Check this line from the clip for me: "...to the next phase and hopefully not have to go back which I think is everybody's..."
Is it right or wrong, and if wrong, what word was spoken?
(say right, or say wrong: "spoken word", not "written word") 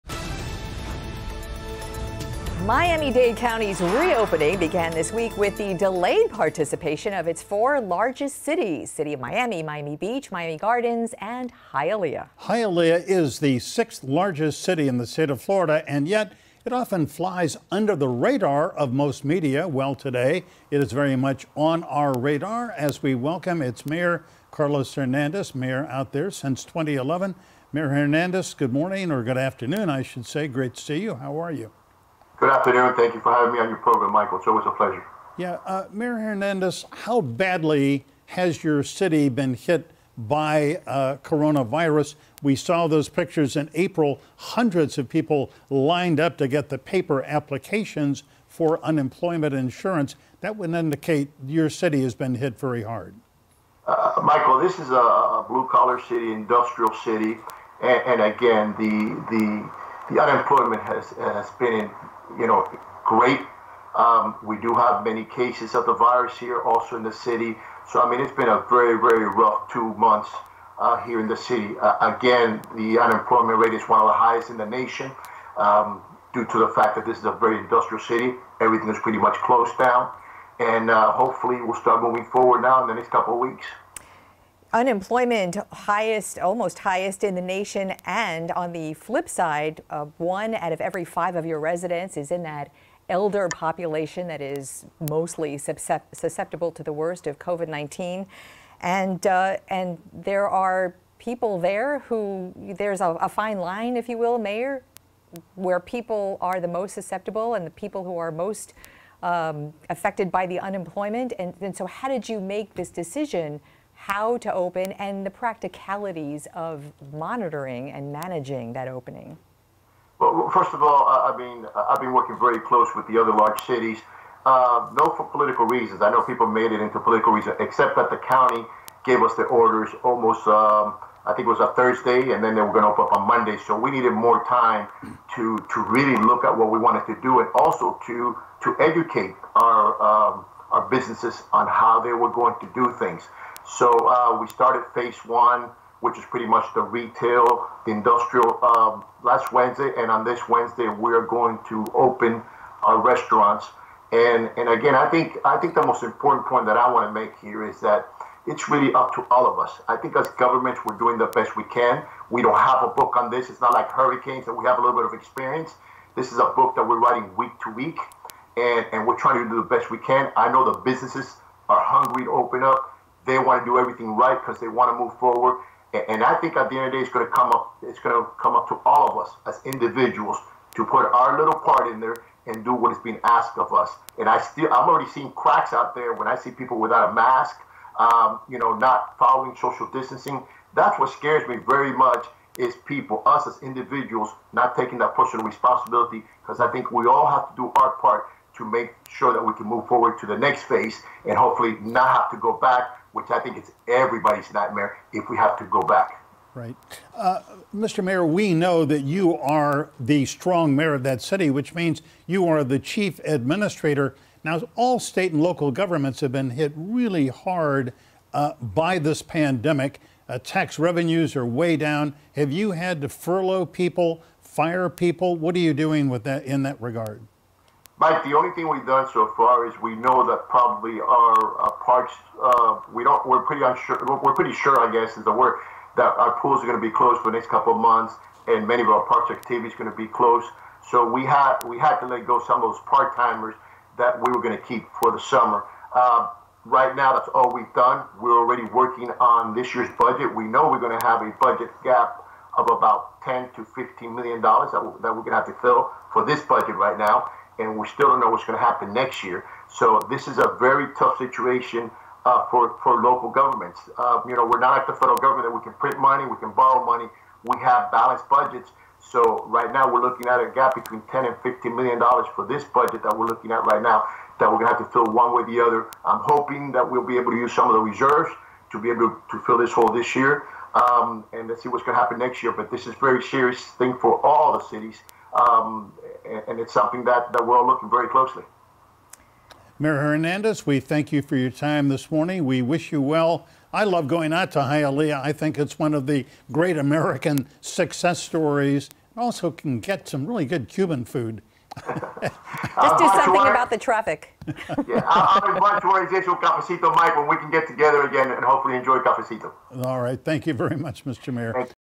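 right.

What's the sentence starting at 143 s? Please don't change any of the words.
So uh, we started phase one, which is pretty much the retail, the industrial, um, last Wednesday.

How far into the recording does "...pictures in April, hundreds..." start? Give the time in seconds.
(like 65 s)
43 s.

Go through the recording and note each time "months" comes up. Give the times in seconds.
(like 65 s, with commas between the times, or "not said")
69 s, 237 s.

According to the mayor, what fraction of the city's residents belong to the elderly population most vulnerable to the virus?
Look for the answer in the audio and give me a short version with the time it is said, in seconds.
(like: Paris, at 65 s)
one out of every five, at 90 s.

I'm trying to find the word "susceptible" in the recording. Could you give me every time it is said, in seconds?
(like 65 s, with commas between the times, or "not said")
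95 s, 106 s.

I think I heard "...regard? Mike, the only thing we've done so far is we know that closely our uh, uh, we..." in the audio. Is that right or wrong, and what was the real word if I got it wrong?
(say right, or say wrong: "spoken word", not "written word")
wrong: "probably", not "closely".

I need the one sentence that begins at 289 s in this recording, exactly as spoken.
Mayor Hernandez, we thank you for your time this morning.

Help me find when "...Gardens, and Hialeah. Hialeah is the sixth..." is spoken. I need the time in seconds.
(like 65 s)
10 s.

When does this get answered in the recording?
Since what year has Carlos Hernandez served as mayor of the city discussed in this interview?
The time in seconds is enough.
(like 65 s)
26 s.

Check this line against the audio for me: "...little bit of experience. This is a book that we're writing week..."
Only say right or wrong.
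right.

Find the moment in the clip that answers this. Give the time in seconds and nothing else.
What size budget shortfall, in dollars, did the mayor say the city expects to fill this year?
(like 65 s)
253 s.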